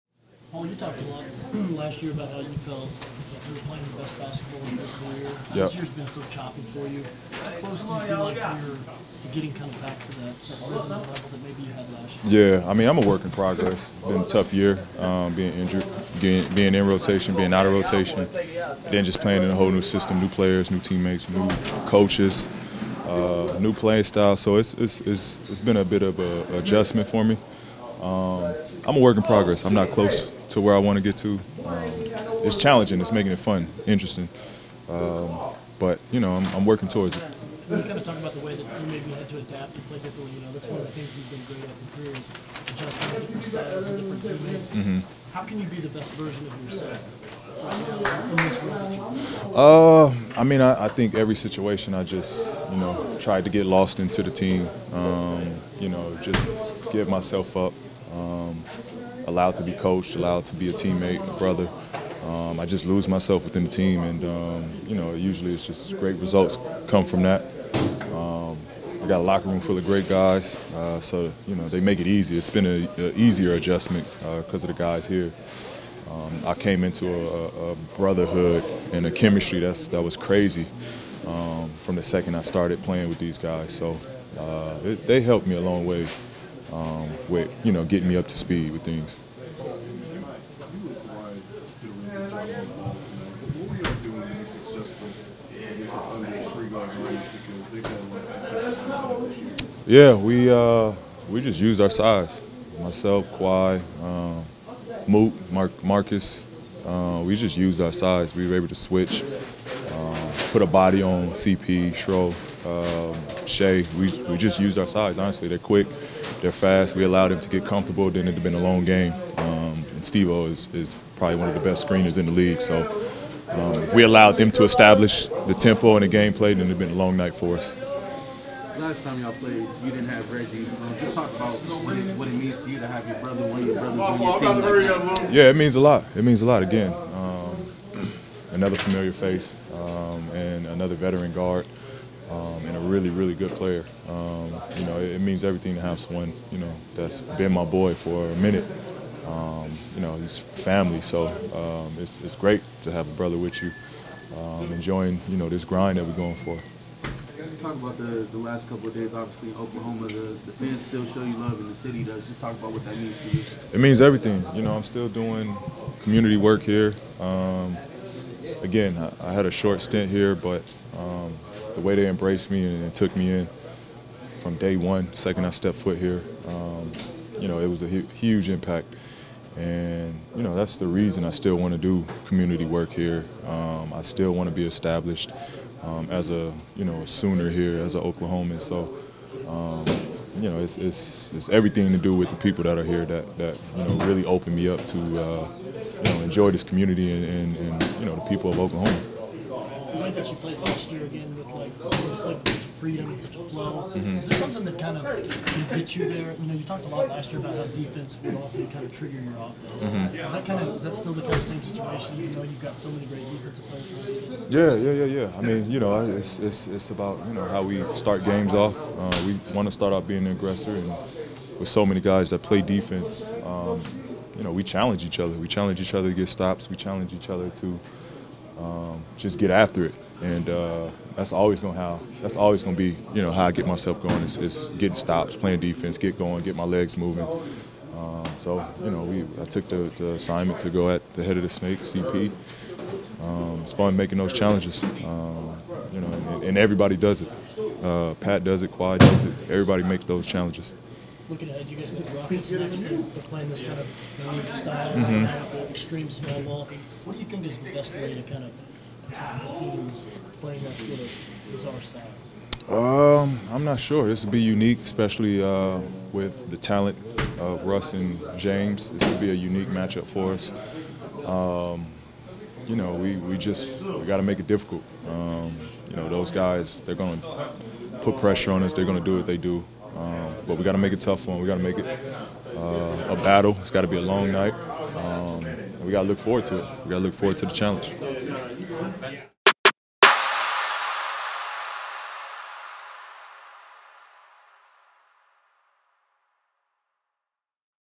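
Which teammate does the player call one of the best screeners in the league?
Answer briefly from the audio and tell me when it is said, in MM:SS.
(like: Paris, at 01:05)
Steve O, at 02:00.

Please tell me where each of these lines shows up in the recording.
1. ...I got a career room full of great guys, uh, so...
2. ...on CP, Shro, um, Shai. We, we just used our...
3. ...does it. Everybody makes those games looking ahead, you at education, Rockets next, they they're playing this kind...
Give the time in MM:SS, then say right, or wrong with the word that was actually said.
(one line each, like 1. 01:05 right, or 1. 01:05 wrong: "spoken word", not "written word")
1. 01:09 wrong: "locker", not "career"
2. 01:51 right
3. 04:09 wrong: "challenges", not "games".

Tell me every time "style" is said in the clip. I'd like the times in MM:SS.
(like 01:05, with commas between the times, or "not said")
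00:24, 00:43, 04:14, 04:21.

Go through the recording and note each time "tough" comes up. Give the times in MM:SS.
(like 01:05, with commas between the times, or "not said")
00:14, 04:41.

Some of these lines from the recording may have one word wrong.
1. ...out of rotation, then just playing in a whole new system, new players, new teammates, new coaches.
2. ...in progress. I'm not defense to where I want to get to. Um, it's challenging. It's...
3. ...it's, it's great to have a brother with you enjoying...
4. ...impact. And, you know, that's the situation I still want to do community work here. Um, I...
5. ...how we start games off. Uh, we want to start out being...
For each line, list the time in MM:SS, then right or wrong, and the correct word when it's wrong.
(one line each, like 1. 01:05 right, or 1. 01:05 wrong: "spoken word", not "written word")
1. 00:17 right
2. 00:29 wrong: "close", not "defense"
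3. 02:31 right
4. 02:58 wrong: "reason", not "situation"
5. 03:37 right.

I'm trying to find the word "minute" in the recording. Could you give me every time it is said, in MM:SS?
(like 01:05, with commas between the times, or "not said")
02:28.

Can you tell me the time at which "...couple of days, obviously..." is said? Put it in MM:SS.
02:38.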